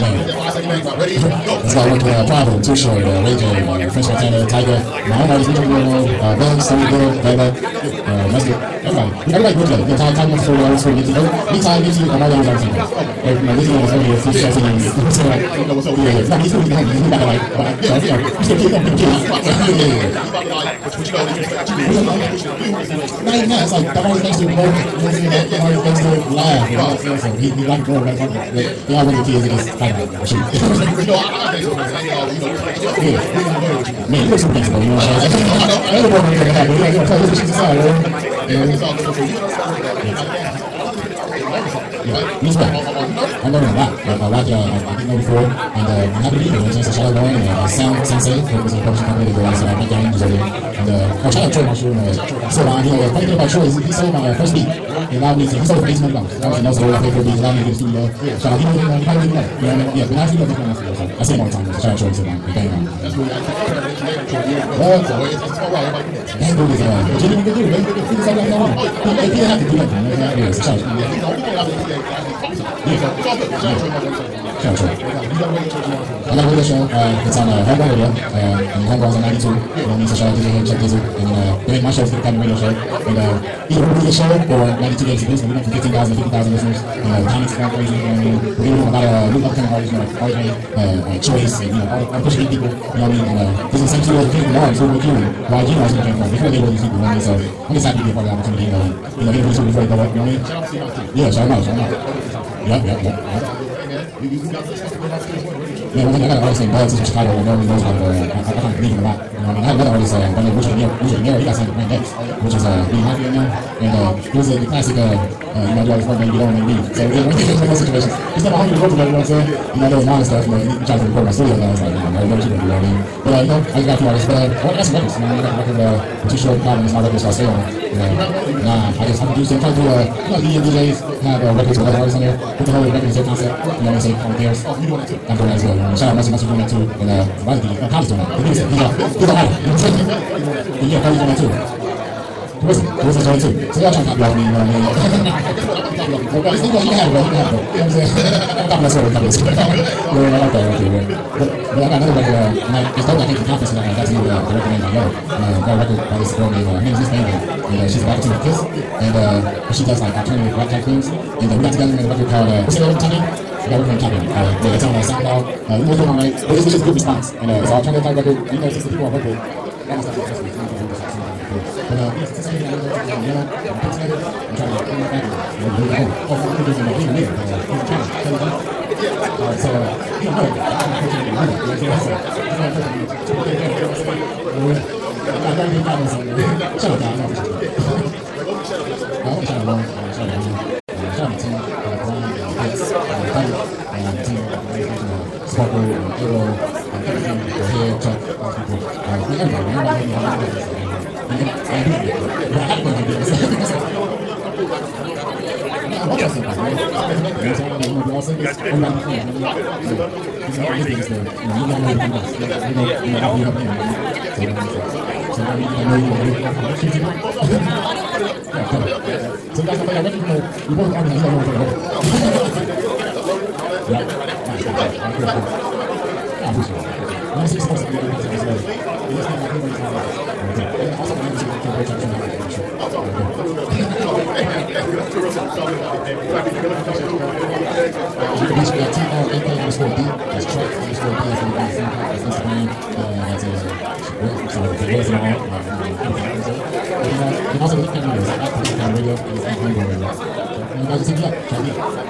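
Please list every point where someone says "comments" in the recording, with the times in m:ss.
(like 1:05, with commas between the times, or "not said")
1:27.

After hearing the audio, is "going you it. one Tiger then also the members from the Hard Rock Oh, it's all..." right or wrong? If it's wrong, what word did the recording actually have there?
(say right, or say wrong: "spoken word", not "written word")
wrong: "And", not "Tiger".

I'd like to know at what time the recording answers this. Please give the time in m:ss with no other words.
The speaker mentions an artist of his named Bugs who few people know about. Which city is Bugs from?
1:47.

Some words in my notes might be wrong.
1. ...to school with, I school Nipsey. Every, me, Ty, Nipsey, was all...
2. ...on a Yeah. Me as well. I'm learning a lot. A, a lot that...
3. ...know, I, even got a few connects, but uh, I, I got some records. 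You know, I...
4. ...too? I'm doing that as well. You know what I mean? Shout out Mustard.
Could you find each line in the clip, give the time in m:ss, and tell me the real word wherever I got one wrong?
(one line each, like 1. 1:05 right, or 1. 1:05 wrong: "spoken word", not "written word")
1. 0:10 right
2. 0:38 right
3. 2:03 wrong: "artists", not "connects"
4. 2:15 right.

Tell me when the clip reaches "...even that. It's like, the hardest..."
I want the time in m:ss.
0:23.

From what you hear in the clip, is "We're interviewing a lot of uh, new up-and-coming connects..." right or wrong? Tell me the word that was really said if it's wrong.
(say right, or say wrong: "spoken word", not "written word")
wrong: "artists", not "connects".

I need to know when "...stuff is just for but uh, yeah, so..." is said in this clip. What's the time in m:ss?
2:50.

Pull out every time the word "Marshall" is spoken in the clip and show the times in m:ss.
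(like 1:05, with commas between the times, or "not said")
0:51.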